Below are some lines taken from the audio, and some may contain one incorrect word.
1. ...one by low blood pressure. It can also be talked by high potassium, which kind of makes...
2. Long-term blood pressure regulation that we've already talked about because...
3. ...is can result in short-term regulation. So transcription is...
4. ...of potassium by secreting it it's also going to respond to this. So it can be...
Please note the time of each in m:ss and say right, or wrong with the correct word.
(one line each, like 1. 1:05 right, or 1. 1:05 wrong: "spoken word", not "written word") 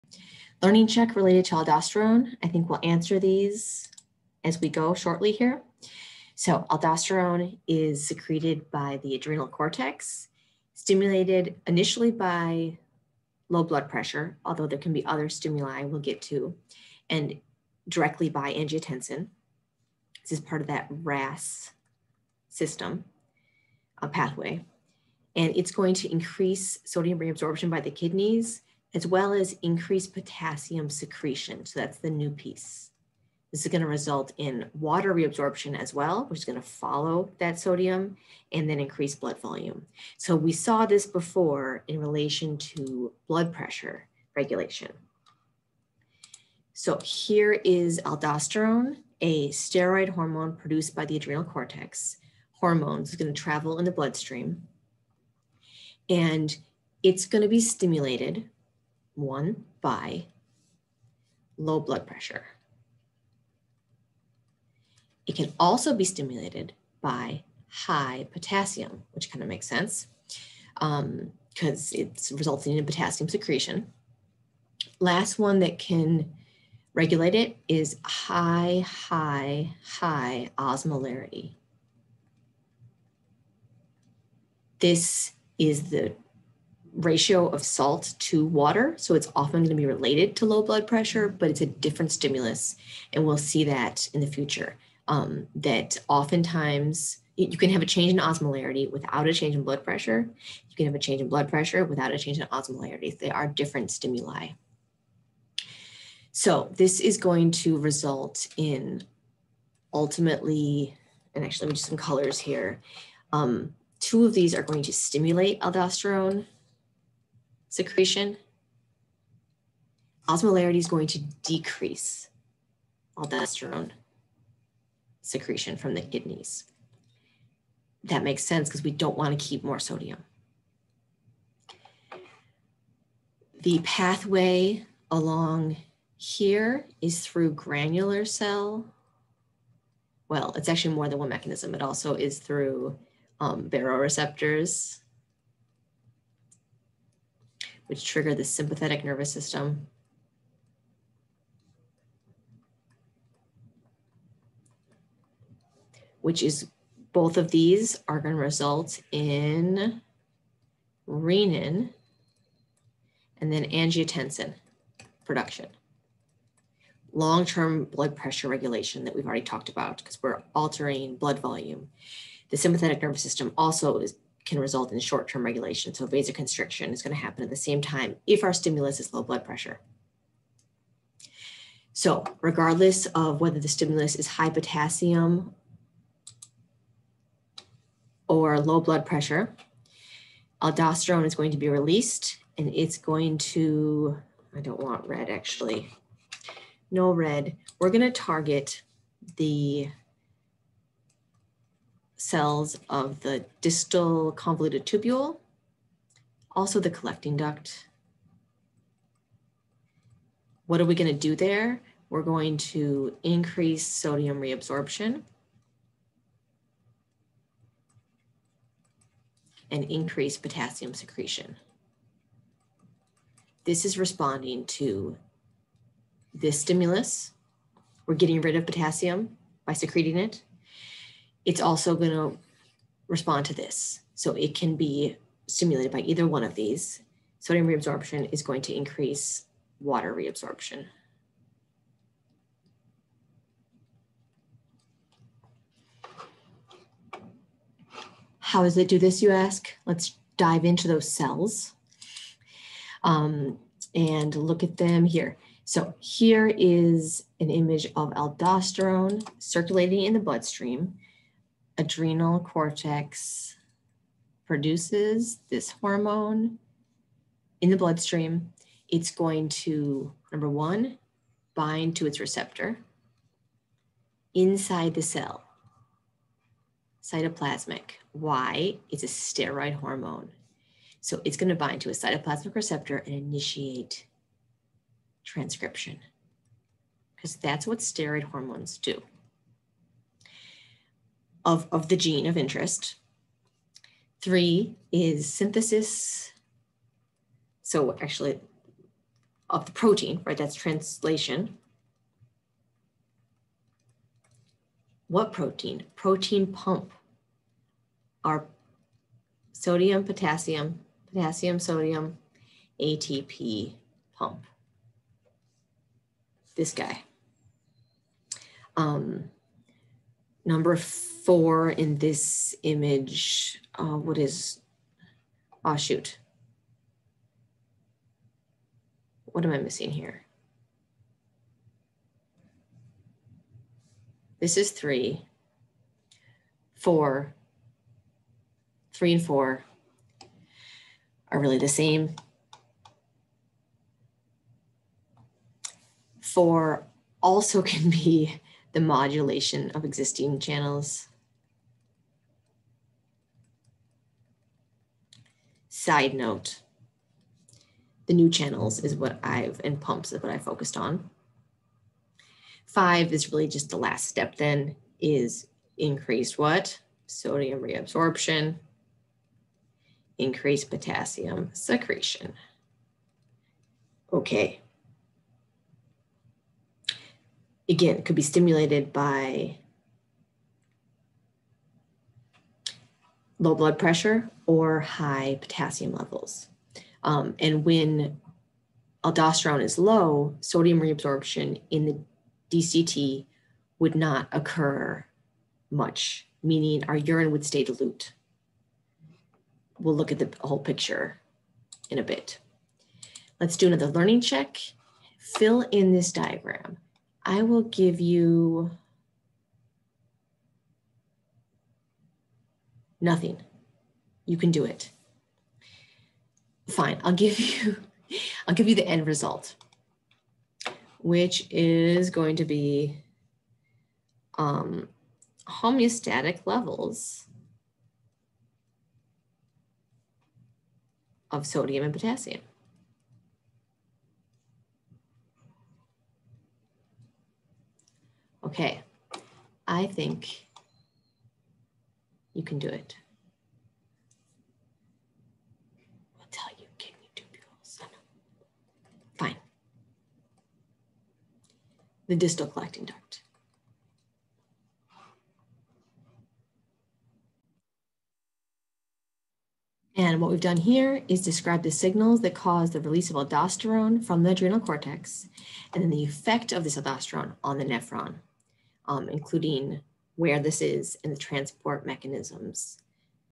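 1. 0:59 wrong: "stimulated", not "talked"
2. 2:47 right
3. 2:53 wrong: "vasoconstriction", not "transcription"
4. 3:48 right.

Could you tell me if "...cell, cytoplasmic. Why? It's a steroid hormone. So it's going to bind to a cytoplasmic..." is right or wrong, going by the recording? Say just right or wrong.
right.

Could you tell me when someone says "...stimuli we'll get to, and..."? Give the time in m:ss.
0:15.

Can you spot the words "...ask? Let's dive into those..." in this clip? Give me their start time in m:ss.
4:09.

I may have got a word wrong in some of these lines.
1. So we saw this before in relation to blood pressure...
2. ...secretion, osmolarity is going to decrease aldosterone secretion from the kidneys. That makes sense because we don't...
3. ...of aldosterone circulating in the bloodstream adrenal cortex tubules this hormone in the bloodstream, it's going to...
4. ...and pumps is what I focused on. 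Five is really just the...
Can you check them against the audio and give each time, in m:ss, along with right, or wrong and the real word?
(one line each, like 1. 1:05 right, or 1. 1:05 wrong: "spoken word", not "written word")
1. 0:40 right
2. 1:57 right
3. 4:17 wrong: "produces", not "tubules"
4. 5:59 right.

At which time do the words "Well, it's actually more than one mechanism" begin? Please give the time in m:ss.
2:20.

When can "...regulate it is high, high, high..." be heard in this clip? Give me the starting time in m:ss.
1:16.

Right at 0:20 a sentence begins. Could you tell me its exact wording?
This is part of that RAS system uh, pathway.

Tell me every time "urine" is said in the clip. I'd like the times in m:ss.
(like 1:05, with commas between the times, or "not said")
6:36.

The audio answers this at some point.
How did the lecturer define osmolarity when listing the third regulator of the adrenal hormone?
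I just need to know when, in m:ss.
1:26.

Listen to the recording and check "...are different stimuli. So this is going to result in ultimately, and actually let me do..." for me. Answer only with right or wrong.
right.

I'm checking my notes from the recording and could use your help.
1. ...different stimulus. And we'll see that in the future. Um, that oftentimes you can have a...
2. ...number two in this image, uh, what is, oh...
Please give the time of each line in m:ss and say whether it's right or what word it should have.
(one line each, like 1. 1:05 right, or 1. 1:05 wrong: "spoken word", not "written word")
1. 1:31 right
2. 5:20 wrong: "four", not "two".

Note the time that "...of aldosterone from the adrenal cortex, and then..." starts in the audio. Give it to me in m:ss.
7:43.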